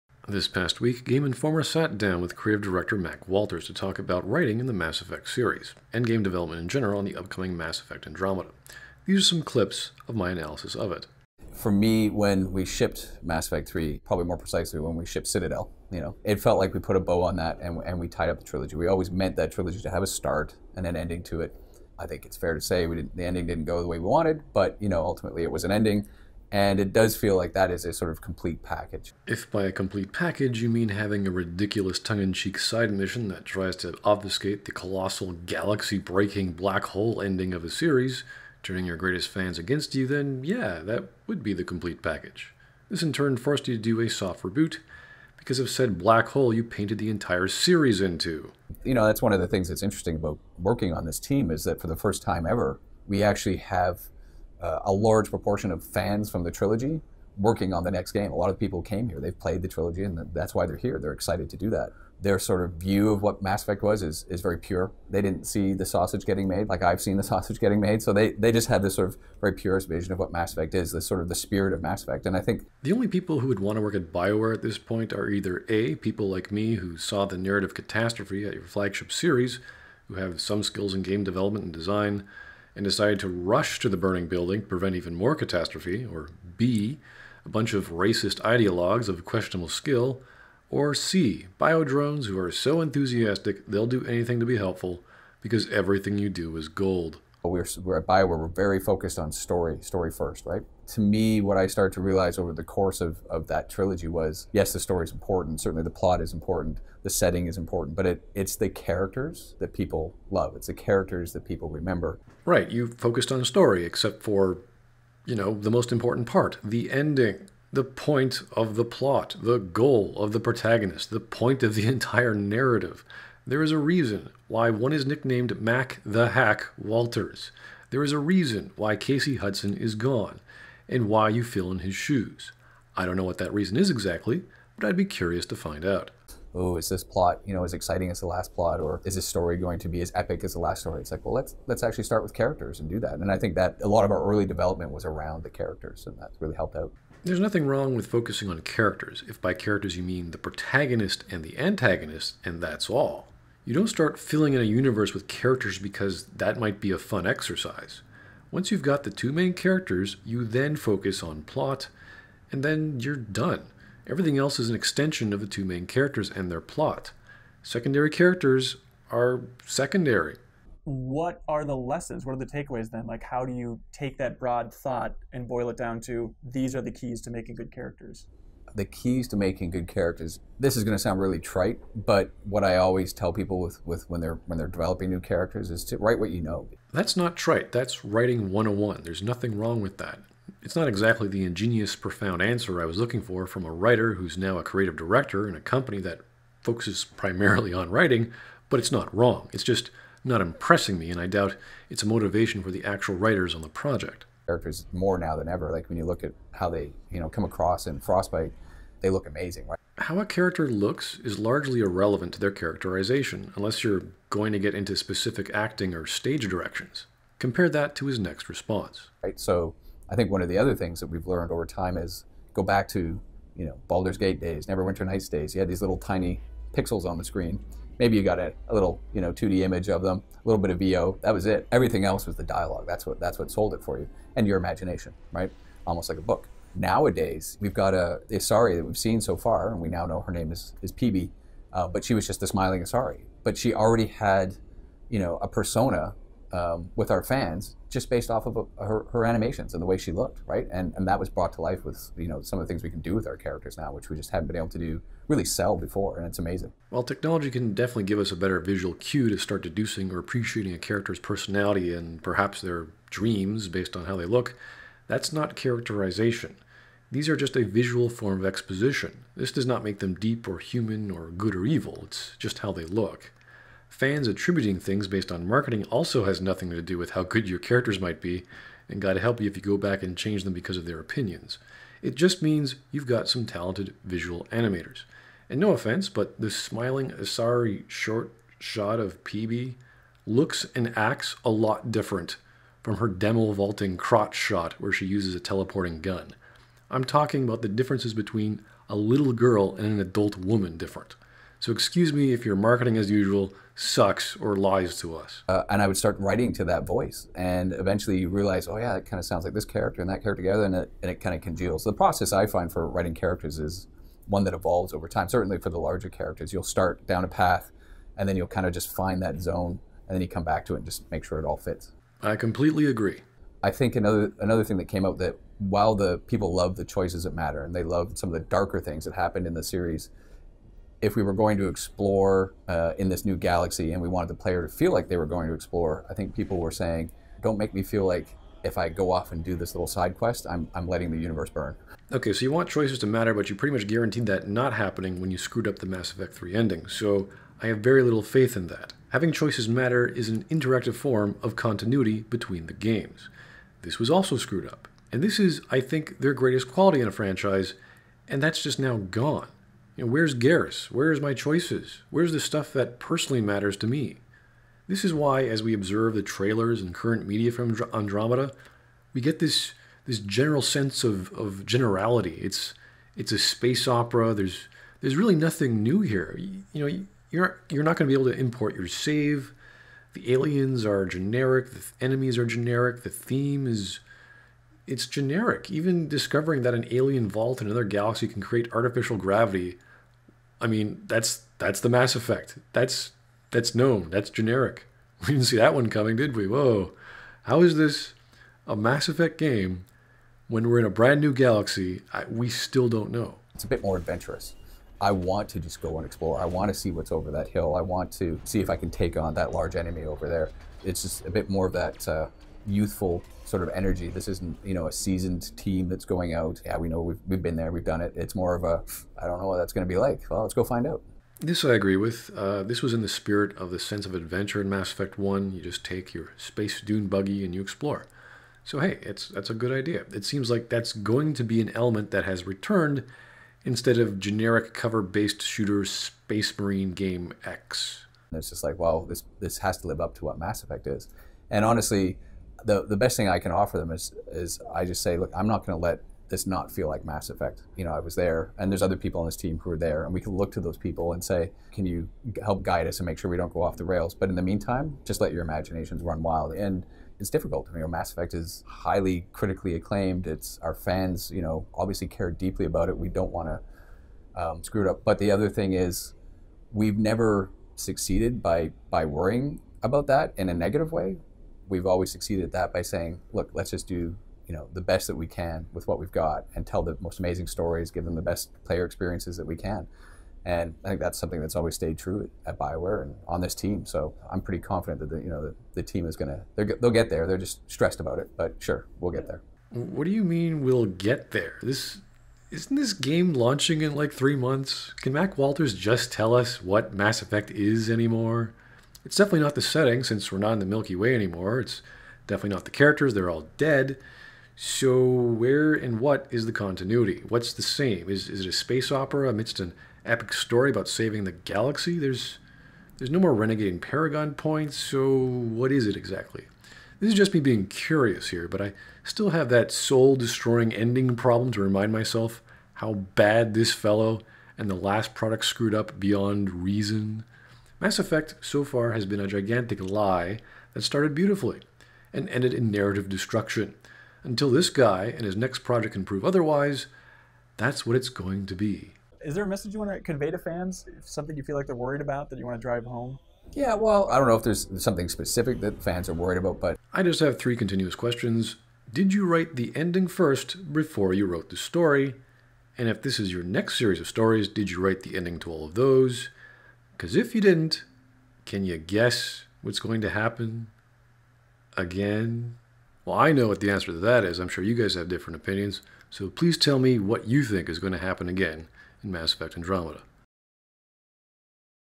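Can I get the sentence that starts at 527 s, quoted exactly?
Mass Effect so far has been a gigantic lie that started beautifully and ended in narrative destruction.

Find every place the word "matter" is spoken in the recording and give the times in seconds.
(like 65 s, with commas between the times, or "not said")
327 s, 343 s, 349 s, 363 s.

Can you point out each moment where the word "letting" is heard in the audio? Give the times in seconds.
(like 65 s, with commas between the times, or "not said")
340 s.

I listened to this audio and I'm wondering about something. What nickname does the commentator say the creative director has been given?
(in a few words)
Mac the Hack Walters.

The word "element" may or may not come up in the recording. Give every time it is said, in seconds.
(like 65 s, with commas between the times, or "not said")
431 s.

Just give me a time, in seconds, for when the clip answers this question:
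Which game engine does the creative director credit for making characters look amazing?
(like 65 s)
207 s.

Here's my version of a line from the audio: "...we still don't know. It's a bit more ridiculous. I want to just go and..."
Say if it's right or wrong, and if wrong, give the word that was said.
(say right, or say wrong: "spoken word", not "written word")
wrong: "adventurous", not "ridiculous".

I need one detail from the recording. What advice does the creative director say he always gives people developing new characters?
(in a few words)
Write what you know.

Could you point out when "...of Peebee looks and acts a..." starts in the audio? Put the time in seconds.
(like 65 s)
289 s.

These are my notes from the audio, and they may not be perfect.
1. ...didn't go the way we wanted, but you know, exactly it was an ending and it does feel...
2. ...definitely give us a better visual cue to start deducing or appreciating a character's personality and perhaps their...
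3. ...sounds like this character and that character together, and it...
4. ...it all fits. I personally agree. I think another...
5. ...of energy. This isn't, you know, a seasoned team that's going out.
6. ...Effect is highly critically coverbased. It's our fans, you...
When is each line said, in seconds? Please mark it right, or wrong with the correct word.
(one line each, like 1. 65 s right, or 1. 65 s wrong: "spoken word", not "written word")
1. 23 s wrong: "ultimately", not "exactly"
2. 257 s right
3. 309 s right
4. 321 s wrong: "completely", not "personally"
5. 413 s right
6. 458 s wrong: "acclaimed", not "coverbased".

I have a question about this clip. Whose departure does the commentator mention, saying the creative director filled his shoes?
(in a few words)
Casey Hudson.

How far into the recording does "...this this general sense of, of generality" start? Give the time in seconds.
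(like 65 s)
369 s.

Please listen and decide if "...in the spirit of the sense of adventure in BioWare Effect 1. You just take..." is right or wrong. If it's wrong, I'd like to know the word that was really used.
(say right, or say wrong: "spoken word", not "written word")
wrong: "Mass", not "BioWare".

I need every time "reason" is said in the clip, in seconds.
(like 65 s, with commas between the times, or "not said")
123 s, 128 s, 133 s, 526 s.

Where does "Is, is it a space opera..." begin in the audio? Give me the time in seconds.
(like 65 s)
508 s.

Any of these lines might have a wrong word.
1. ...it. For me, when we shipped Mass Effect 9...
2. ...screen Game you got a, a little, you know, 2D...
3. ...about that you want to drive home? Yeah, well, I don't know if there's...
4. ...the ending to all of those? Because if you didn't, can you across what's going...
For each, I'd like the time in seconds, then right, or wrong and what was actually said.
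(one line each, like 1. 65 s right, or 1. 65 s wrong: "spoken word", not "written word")
1. 10 s wrong: "3", not "9"
2. 227 s wrong: "Maybe", not "Game"
3. 542 s right
4. 555 s wrong: "guess", not "across".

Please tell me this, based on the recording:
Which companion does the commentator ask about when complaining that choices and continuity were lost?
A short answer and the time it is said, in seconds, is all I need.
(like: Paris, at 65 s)
Garrus, at 360 s.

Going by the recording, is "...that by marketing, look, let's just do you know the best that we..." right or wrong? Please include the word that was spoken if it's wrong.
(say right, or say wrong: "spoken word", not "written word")
wrong: "saying", not "marketing".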